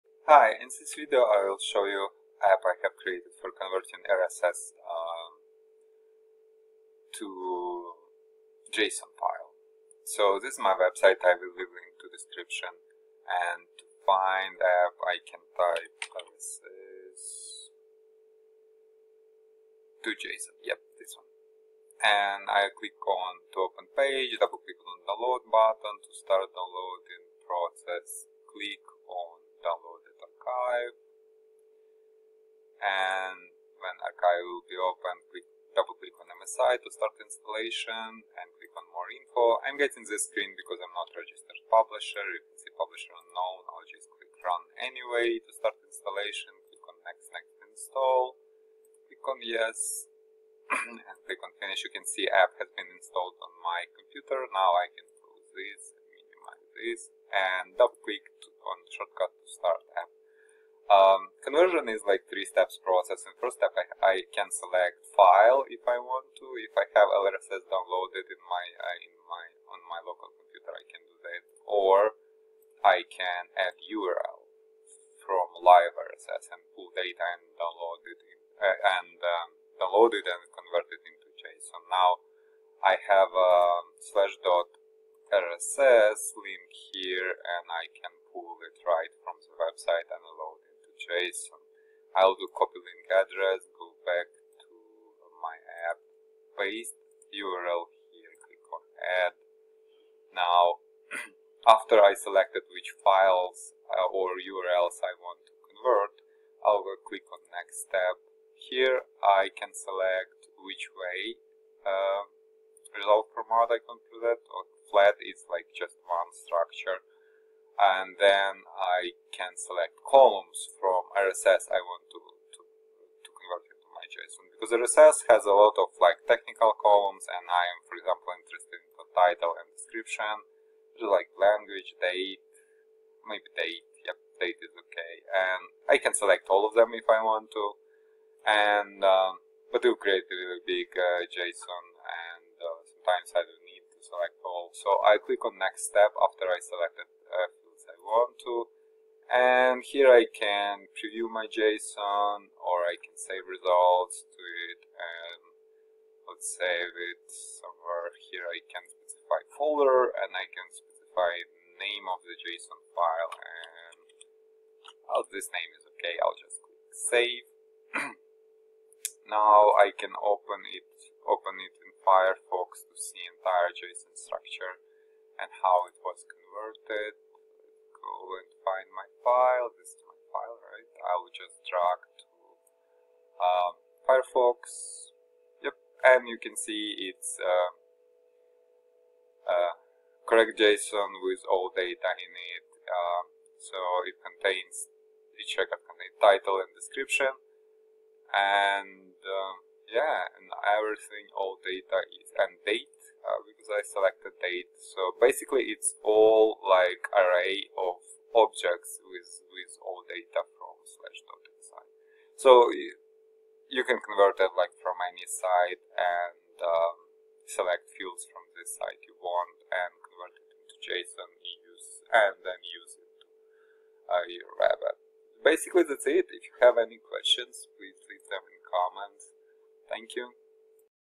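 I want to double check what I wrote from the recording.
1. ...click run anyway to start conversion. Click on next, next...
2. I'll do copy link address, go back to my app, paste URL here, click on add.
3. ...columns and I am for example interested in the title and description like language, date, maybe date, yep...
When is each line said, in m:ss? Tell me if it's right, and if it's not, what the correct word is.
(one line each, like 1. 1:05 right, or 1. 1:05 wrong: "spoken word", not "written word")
1. 0:44 wrong: "installation", not "conversion"
2. 1:32 right
3. 2:06 right.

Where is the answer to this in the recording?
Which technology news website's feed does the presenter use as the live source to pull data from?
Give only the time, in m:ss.
1:24.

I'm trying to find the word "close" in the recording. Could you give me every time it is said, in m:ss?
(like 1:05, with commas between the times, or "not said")
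0:55.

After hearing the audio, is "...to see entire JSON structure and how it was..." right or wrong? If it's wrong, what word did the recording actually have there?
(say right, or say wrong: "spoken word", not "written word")
right.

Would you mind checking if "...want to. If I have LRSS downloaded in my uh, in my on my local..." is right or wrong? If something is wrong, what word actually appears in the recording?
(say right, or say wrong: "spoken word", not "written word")
right.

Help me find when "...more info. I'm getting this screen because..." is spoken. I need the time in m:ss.
0:38.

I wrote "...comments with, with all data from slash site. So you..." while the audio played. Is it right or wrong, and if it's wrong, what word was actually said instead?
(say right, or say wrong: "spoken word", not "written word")
wrong: "objects", not "comments".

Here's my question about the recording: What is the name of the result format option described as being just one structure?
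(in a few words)
Flat.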